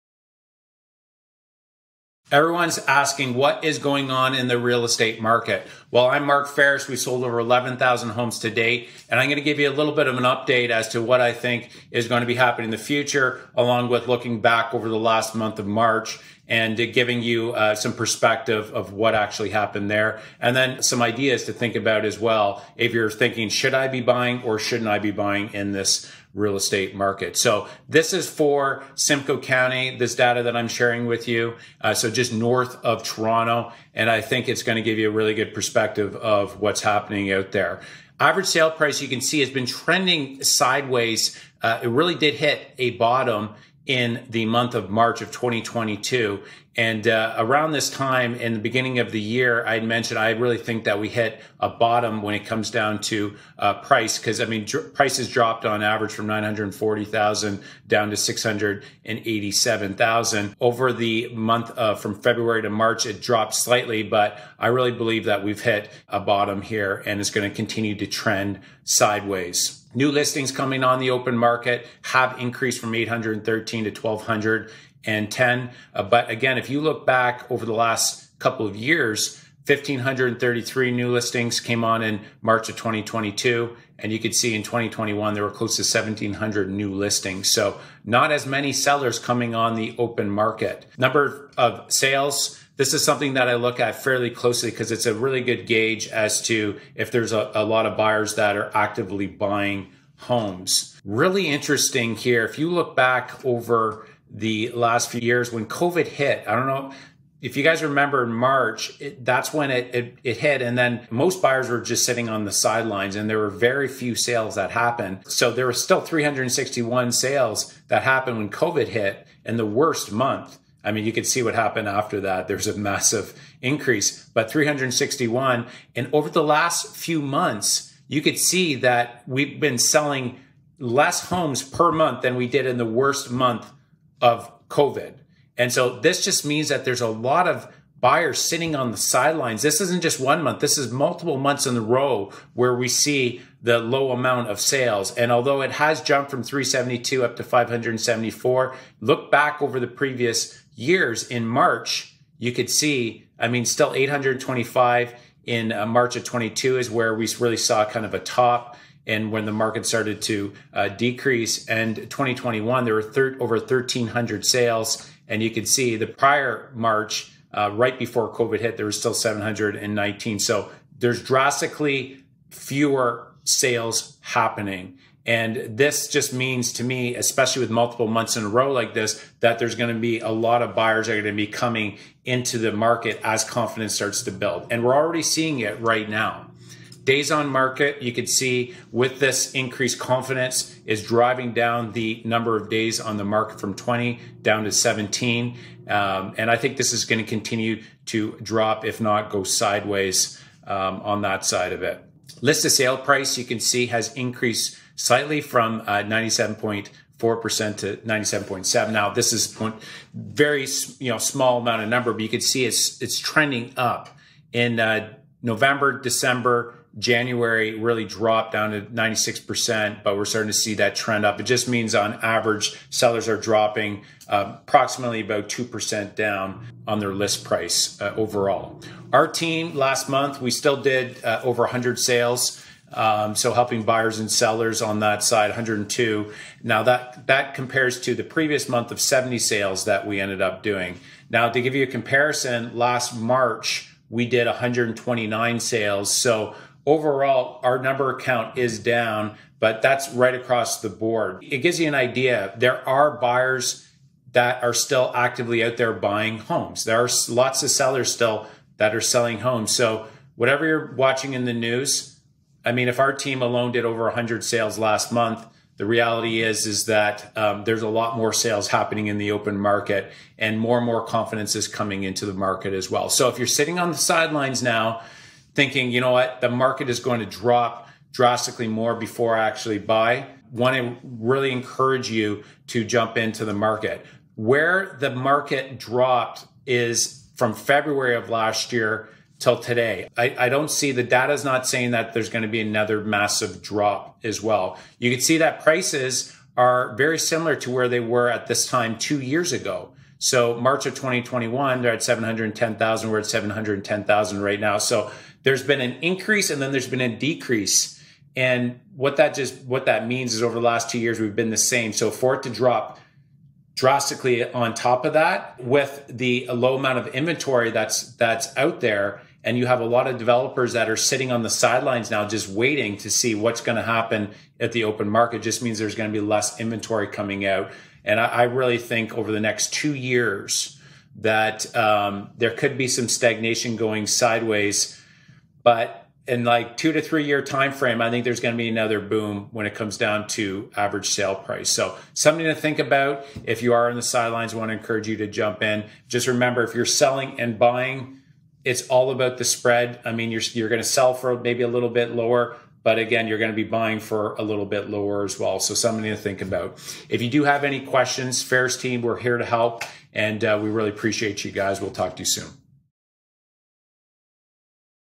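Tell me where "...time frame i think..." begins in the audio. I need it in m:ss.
5:37.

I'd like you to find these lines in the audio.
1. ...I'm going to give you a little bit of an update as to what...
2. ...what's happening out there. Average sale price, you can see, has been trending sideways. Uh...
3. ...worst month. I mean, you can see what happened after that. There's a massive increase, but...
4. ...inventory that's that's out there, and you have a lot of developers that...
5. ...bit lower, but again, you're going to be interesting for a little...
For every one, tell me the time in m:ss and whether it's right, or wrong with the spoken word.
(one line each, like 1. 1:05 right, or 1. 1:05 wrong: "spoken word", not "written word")
1. 0:09 right
2. 0:36 right
3. 1:59 right
4. 5:17 right
5. 5:51 wrong: "buying", not "interesting".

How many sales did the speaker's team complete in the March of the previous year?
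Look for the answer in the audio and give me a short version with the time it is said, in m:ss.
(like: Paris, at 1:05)
129, at 4:04.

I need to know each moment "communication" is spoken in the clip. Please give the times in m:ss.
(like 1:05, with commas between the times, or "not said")
not said.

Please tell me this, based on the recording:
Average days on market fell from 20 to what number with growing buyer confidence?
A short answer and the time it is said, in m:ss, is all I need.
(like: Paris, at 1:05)
17, at 3:14.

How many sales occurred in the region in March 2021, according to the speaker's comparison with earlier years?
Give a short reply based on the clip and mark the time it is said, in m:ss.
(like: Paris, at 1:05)
over 1,300, at 2:43.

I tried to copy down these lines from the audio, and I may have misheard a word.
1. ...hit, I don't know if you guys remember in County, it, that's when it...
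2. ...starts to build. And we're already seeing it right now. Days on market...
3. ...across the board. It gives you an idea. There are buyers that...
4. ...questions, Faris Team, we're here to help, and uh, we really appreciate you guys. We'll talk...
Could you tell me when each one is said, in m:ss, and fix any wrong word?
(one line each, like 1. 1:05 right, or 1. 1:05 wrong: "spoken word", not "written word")
1. 1:46 wrong: "March", not "County"
2. 3:03 right
3. 4:10 right
4. 5:57 right.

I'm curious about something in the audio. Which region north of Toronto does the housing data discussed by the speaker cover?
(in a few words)
Simcoe County.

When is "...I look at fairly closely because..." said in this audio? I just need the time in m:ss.
1:33.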